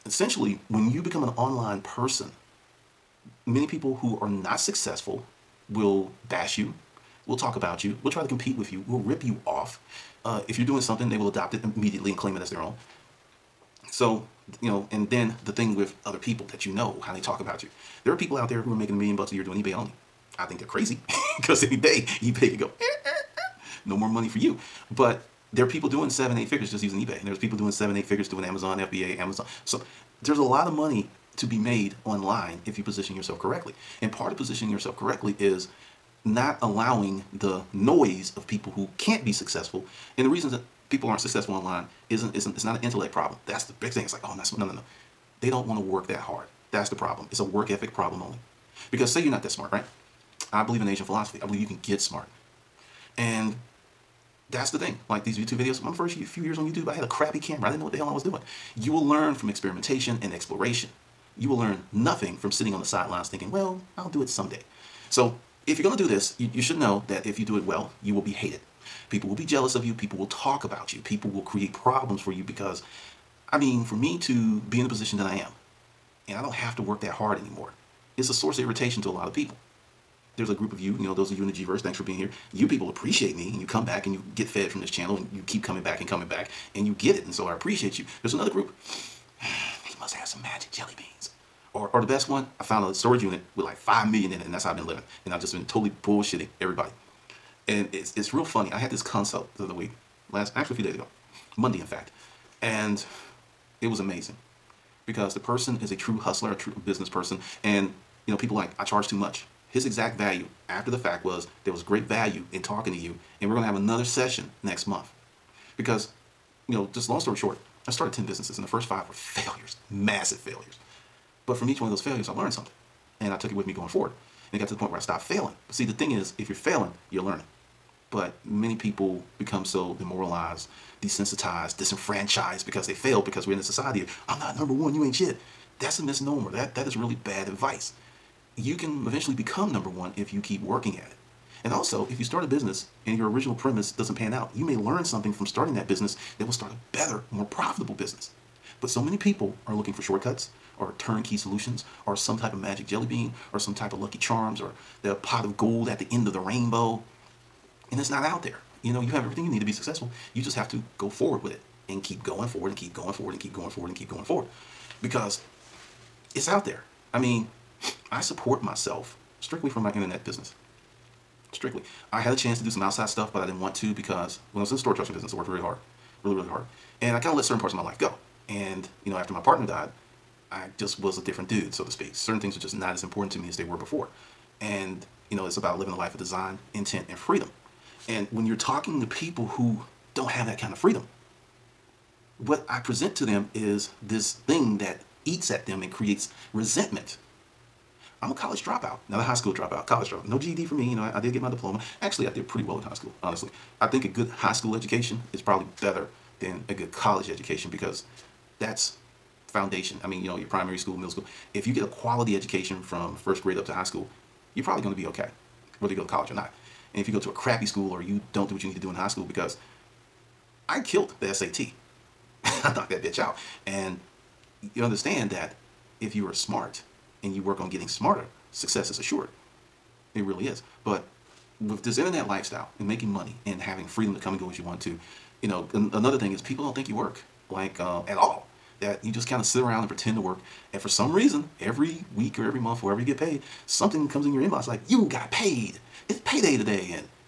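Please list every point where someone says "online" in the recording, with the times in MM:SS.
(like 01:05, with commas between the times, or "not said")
00:01, 00:32, 00:41.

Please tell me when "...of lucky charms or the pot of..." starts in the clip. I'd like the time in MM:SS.
02:33.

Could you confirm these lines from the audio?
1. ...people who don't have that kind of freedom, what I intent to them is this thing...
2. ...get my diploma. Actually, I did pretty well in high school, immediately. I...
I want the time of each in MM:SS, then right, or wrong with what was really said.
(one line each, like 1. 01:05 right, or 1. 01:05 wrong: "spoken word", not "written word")
1. 03:09 wrong: "present", not "intent"
2. 03:21 wrong: "honestly", not "immediately".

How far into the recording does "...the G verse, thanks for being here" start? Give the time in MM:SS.
01:21.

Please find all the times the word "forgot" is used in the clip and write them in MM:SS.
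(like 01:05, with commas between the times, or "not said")
not said.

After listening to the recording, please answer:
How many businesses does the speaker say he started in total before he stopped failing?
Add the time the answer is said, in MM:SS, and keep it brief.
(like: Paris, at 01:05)
10, at 01:58.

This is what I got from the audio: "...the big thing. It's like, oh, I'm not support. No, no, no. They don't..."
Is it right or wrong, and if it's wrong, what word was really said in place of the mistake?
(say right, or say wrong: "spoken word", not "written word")
wrong: "smart", not "support".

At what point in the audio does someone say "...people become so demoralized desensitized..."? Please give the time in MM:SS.
02:08.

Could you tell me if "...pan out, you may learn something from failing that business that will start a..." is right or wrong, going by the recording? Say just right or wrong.
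wrong.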